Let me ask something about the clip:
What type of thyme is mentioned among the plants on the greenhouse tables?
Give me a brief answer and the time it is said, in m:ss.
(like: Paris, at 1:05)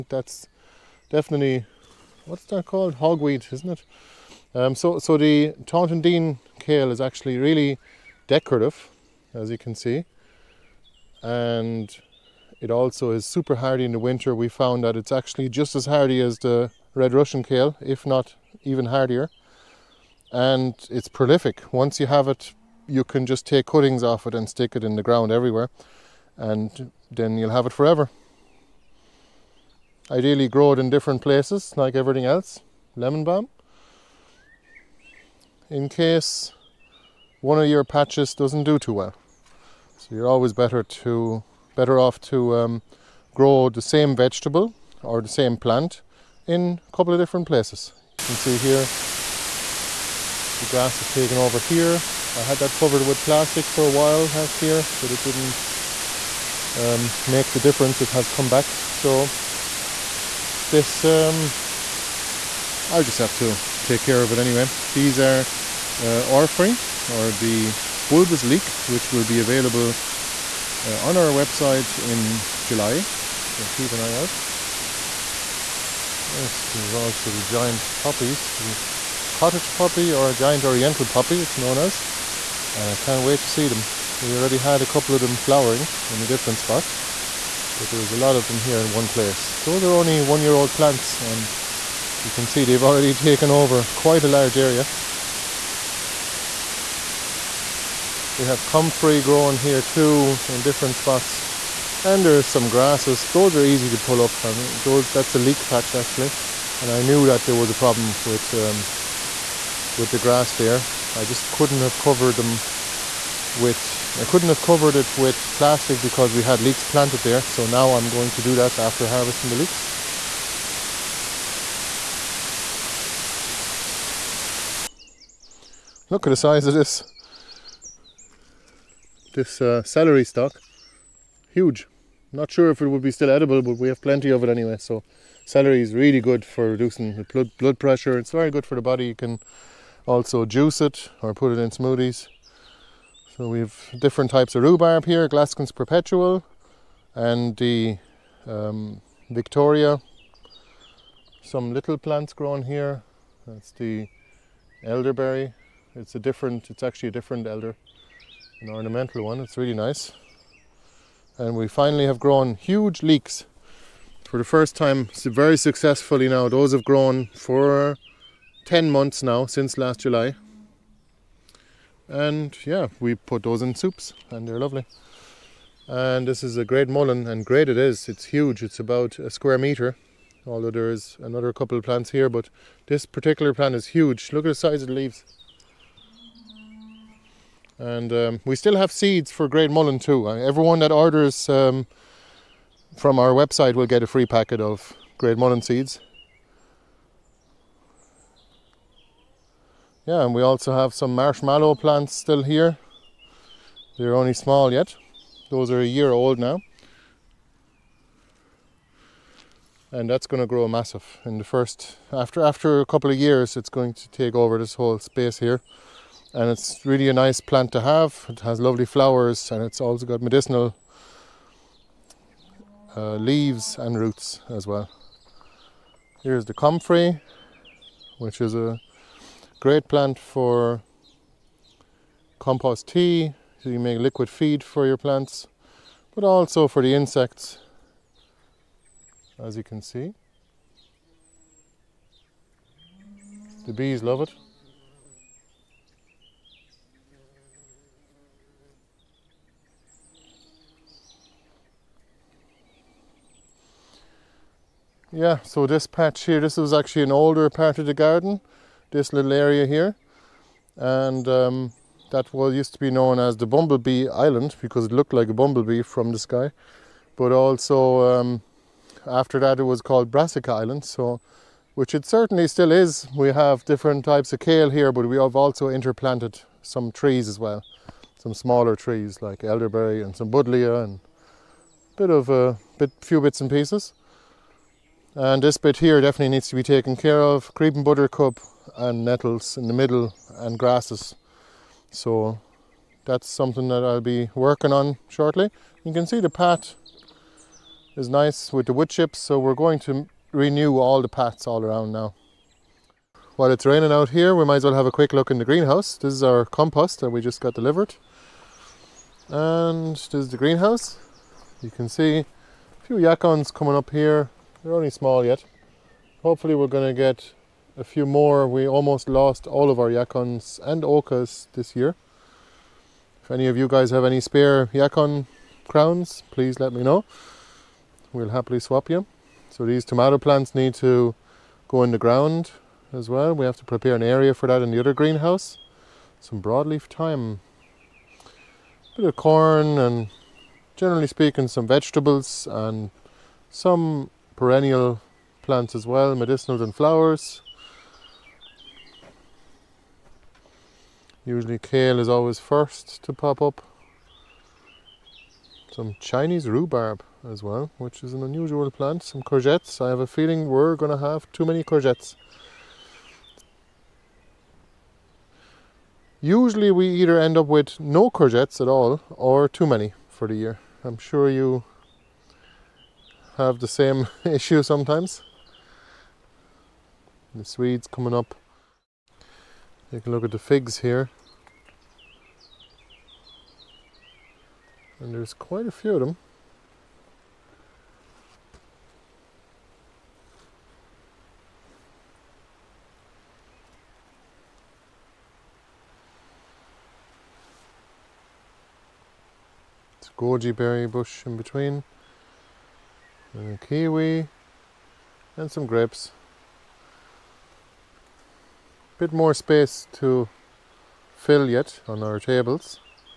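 broadleaf thyme, at 5:36.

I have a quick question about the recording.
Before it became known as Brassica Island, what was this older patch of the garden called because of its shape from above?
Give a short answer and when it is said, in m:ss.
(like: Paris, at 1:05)
Bumblebee Island, at 4:23.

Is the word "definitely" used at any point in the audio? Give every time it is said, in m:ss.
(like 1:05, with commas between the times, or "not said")
0:01, 4:46.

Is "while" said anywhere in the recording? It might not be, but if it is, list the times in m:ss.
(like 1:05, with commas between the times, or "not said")
0:53, 5:03.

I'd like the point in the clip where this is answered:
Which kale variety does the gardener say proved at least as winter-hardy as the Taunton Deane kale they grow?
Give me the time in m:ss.
0:16.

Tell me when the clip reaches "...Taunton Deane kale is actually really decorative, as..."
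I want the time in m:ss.
0:05.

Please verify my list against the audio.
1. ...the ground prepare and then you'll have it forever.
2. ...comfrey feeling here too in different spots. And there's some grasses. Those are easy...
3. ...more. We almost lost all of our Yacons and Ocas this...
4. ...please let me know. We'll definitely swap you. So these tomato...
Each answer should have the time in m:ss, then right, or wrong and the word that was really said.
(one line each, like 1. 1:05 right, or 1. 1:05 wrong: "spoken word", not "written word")
1. 0:24 wrong: "everywhere", not "prepare"
2. 1:38 wrong: "growing", not "feeling"
3. 5:18 right
4. 5:26 wrong: "happily", not "definitely".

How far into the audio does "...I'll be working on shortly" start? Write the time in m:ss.
4:53.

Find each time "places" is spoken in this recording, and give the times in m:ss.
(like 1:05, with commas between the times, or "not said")
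0:31, 0:47, 1:29.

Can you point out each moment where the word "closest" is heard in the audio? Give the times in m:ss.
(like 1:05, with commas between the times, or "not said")
not said.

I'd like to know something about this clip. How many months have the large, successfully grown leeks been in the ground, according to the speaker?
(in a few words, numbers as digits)
10.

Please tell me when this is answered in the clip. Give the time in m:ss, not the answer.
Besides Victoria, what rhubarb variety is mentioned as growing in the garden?
2:25.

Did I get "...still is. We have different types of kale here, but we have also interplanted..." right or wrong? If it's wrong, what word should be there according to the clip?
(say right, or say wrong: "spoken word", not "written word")
right.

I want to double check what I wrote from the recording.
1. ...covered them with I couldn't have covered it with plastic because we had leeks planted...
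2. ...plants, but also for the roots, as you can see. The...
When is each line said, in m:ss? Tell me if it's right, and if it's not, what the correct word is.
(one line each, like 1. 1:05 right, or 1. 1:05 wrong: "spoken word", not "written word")
1. 1:51 right
2. 3:54 wrong: "insects", not "roots".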